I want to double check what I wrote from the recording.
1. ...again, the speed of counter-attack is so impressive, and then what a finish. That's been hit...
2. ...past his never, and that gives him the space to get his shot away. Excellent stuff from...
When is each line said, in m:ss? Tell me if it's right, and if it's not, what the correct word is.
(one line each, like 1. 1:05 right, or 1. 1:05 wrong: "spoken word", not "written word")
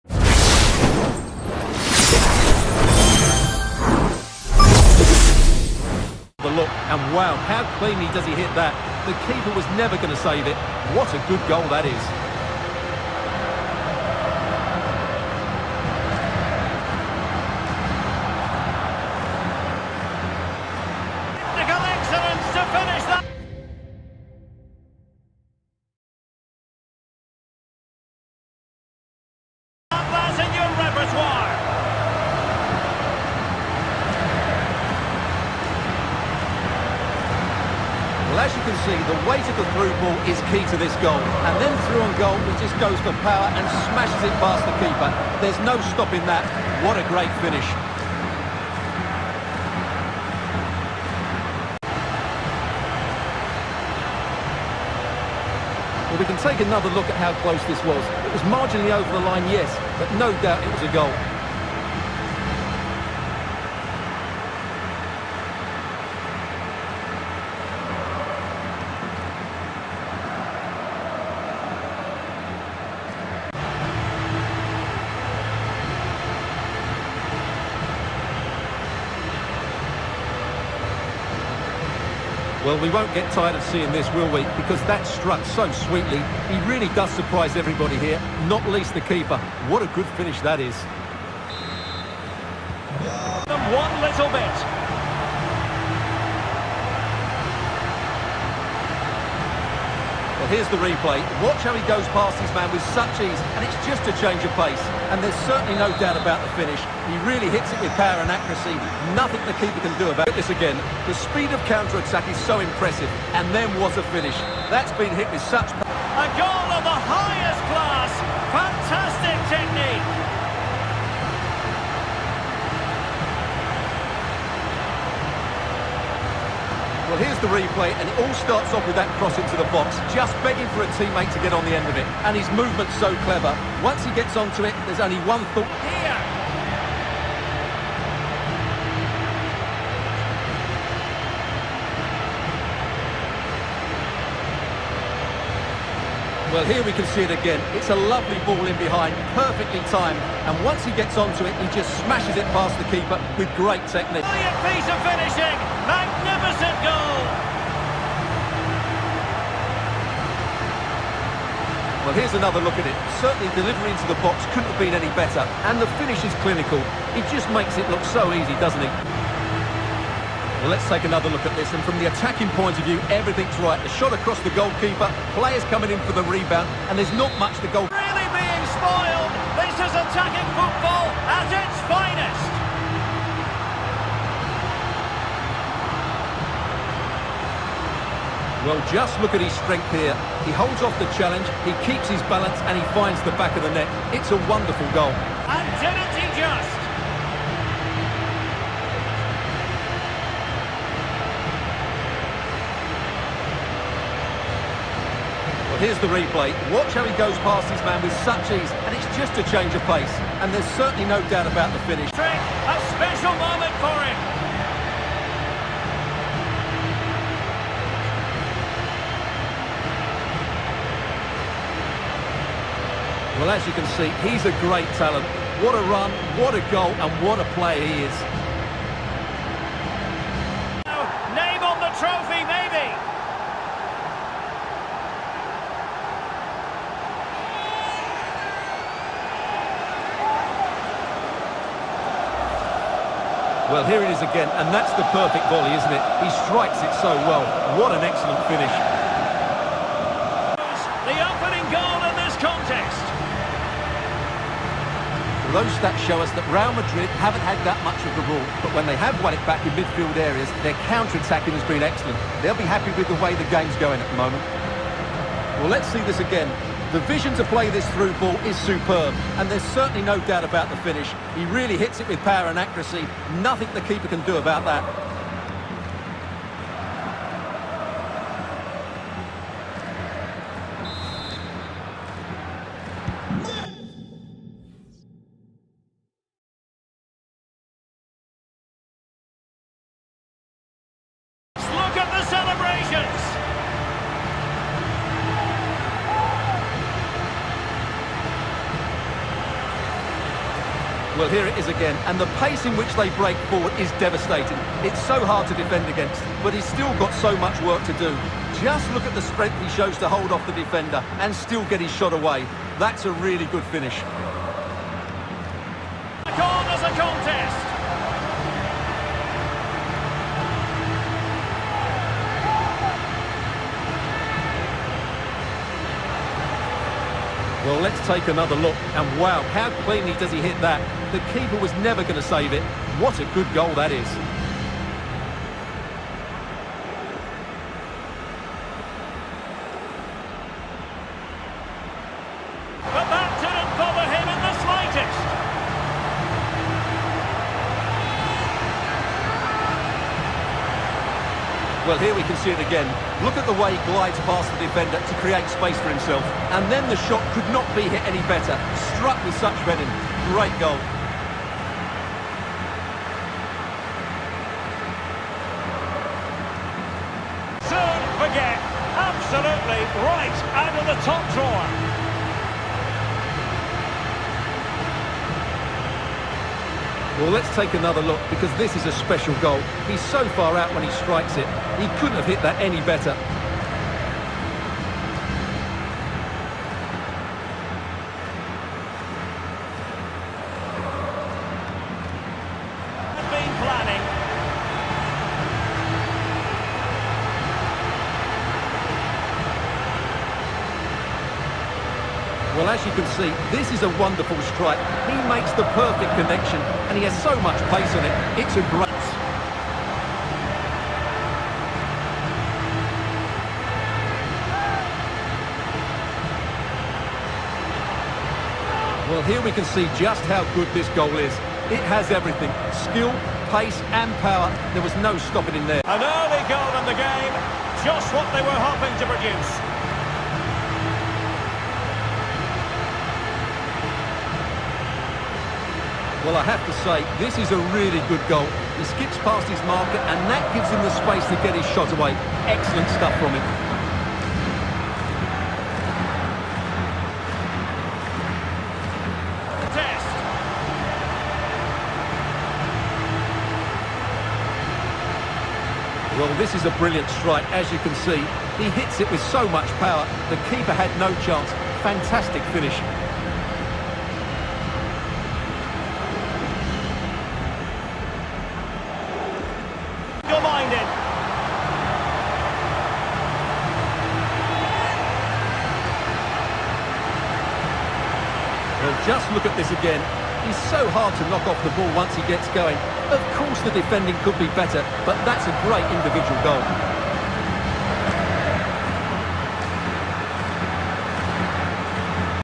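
1. 1:50 right
2. 7:19 wrong: "marker", not "never".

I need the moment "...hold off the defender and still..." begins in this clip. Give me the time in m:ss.
5:10.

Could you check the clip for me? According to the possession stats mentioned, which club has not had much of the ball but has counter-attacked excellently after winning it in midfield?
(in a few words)
Real Madrid.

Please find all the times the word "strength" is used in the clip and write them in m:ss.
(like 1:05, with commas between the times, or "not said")
3:09, 5:09.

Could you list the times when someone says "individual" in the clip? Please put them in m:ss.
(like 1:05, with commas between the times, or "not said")
8:05.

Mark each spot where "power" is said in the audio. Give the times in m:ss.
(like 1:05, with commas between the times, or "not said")
0:43, 1:47, 4:32, 7:04, 7:39.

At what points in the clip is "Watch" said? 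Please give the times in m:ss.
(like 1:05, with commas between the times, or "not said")
1:41, 3:26.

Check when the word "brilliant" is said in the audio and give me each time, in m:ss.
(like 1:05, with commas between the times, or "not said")
2:34, 7:36.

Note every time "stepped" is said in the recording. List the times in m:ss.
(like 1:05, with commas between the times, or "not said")
not said.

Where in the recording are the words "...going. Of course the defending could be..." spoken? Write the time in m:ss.
8:02.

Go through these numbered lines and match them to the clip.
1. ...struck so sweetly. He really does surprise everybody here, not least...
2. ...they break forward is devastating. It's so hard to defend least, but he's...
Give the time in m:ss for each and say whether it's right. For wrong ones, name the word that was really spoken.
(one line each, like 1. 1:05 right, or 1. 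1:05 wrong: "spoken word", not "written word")
1. 1:25 right
2. 5:02 wrong: "against", not "least".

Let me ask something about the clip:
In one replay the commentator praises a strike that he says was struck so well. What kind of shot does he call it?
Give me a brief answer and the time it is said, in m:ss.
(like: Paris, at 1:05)
Perfect volley, at 4:05.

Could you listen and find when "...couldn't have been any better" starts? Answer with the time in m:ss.
2:44.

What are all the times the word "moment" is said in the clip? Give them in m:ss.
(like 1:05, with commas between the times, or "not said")
3:33, 4:24.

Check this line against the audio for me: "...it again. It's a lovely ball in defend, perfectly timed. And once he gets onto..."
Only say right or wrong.
wrong.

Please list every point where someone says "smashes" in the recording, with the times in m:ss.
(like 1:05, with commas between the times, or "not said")
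0:43, 2:32.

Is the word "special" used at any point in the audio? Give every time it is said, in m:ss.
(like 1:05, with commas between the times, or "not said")
3:32, 6:18.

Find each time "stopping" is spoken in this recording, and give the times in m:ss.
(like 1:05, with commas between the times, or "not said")
0:45, 7:05.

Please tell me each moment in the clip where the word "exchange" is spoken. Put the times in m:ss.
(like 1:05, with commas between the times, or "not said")
not said.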